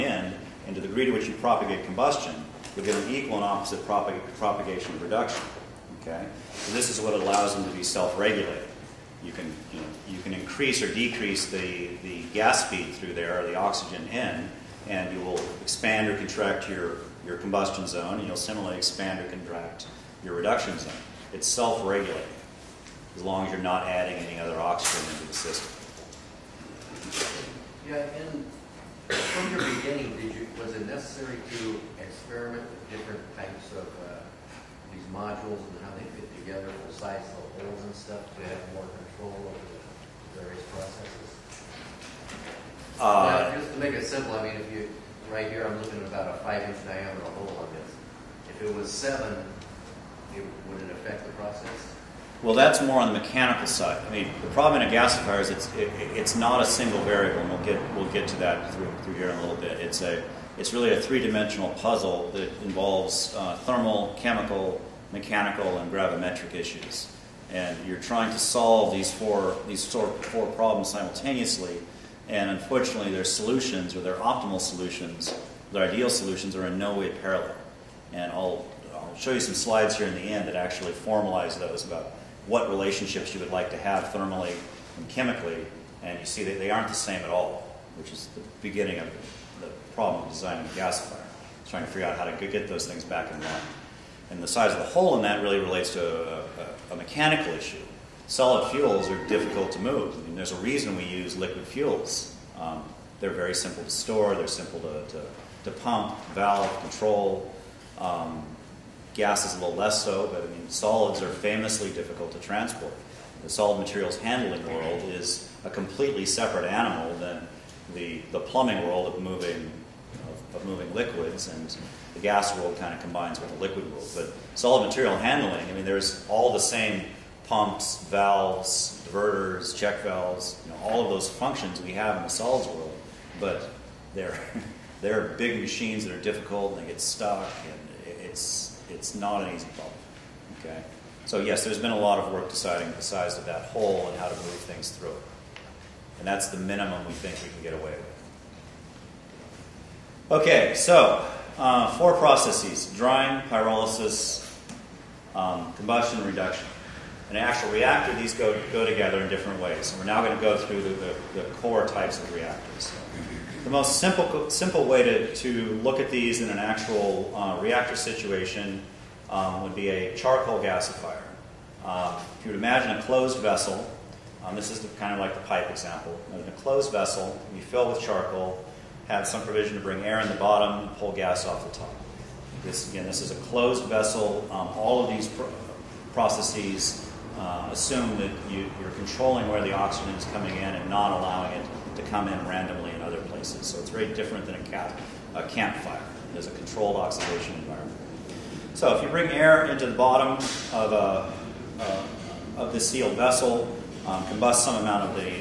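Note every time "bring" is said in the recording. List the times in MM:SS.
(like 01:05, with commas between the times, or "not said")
02:59, 03:19.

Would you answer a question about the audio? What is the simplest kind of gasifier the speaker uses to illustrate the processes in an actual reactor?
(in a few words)
charcoal gasifier.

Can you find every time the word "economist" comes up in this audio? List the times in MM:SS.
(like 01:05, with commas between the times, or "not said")
not said.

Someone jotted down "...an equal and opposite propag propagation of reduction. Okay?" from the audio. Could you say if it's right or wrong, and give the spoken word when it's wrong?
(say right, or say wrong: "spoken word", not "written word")
right.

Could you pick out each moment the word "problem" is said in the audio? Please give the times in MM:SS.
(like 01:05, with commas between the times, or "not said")
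00:54, 01:10, 01:29, 02:19.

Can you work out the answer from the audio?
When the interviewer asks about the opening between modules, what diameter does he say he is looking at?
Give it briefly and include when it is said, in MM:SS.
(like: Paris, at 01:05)
5 inches, at 00:46.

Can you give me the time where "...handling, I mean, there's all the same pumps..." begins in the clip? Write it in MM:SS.
02:05.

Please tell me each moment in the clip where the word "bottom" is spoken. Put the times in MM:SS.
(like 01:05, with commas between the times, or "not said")
03:00, 03:19.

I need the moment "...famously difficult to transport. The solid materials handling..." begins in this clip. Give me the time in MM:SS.
01:51.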